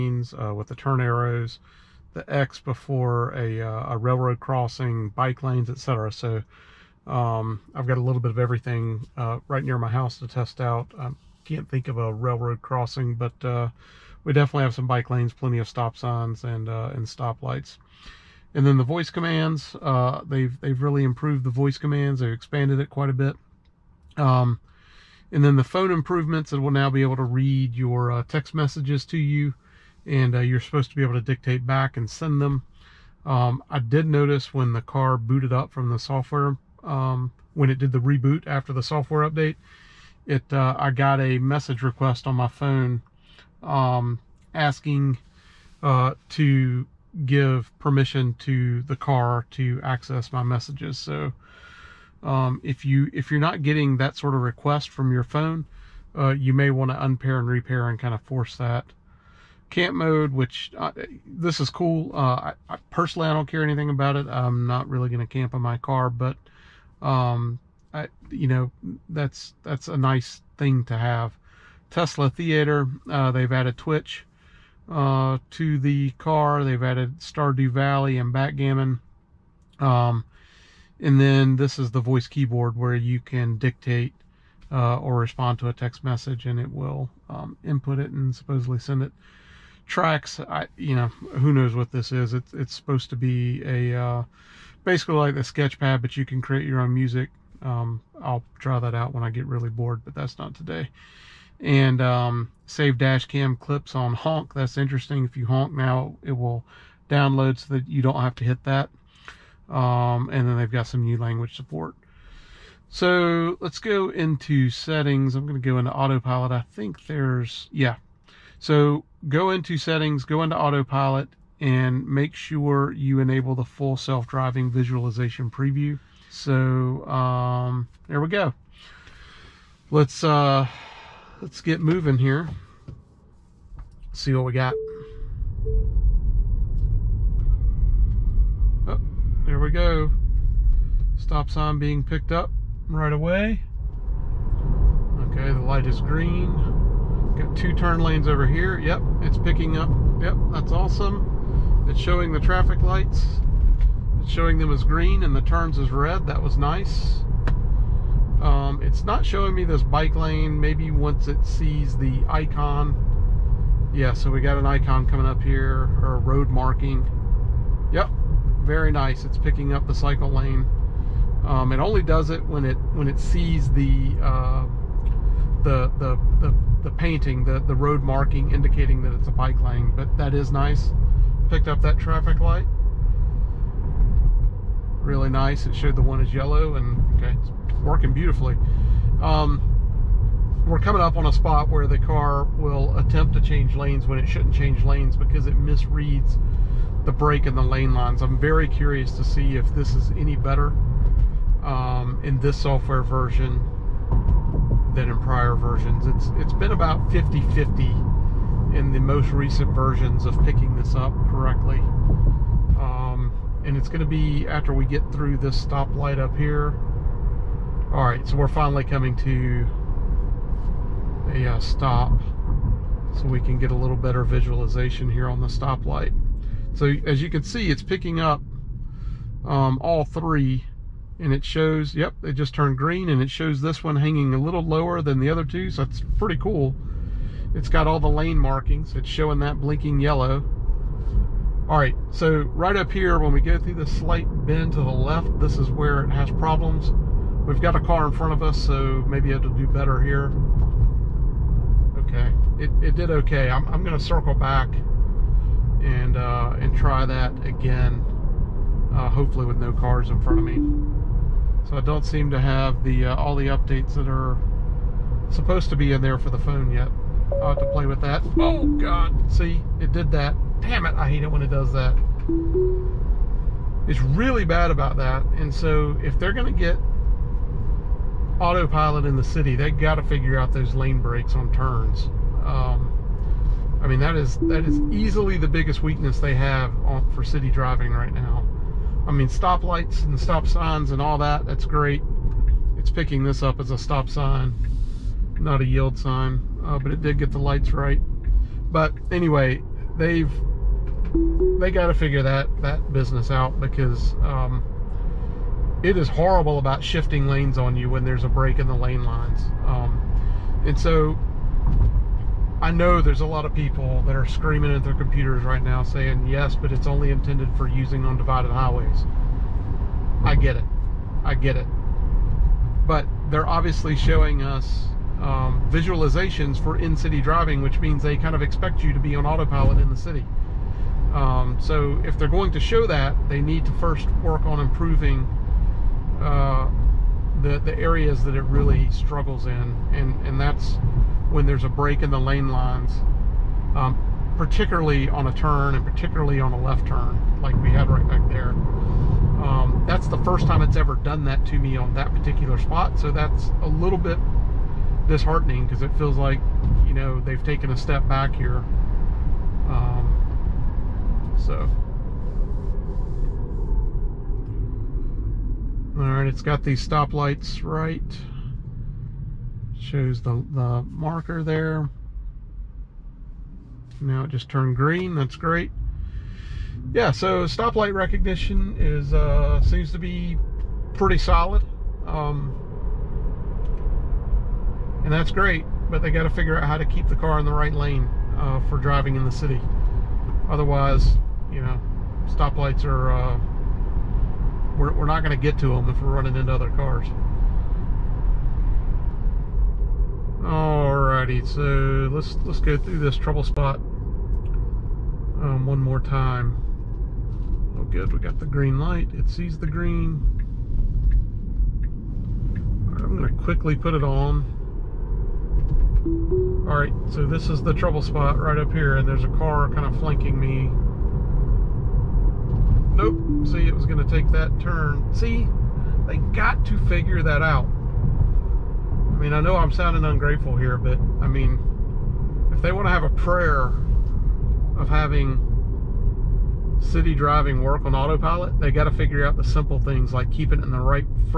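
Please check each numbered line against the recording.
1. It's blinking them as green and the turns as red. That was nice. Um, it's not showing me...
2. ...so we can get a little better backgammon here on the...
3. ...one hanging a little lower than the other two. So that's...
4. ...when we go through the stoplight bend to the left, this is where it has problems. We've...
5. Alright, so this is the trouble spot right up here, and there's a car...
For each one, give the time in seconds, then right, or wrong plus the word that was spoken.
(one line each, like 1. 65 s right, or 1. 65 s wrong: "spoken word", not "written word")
1. 154 s wrong: "showing", not "blinking"
2. 223 s wrong: "visualization", not "backgammon"
3. 233 s right
4. 243 s wrong: "slight", not "stoplight"
5. 416 s right.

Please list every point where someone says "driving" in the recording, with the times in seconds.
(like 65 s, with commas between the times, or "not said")
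123 s, 287 s, 327 s, 388 s, 437 s.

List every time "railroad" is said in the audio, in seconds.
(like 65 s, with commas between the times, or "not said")
3 s, 12 s.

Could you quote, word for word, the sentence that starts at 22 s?
They've expanded it quite a bit.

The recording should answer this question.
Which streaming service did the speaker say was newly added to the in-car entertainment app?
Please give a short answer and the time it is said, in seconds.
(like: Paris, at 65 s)
Twitch, at 73 s.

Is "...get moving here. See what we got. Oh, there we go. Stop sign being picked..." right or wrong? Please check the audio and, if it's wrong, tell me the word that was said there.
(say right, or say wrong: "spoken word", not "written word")
right.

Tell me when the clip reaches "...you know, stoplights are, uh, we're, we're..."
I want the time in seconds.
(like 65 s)
391 s.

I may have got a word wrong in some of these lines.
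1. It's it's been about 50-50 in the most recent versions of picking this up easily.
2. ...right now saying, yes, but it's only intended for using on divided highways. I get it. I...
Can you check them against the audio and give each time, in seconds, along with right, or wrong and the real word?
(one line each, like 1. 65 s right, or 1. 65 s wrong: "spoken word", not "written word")
1. 206 s wrong: "correctly", not "easily"
2. 315 s right.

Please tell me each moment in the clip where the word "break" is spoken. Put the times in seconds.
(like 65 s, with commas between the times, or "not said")
197 s, 281 s, 308 s, 341 s.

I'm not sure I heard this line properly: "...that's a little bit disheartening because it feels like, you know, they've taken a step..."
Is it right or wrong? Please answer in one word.
right.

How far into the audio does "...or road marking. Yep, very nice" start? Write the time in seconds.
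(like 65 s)
166 s.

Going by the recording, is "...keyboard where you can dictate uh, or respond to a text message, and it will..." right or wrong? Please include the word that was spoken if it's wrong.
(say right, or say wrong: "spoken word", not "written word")
right.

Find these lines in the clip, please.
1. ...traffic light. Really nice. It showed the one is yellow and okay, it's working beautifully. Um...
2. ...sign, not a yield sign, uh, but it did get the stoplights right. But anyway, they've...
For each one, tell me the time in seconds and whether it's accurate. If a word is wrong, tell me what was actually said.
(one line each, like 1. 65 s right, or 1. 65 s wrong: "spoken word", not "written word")
1. 181 s right
2. 294 s wrong: "lights", not "stoplights".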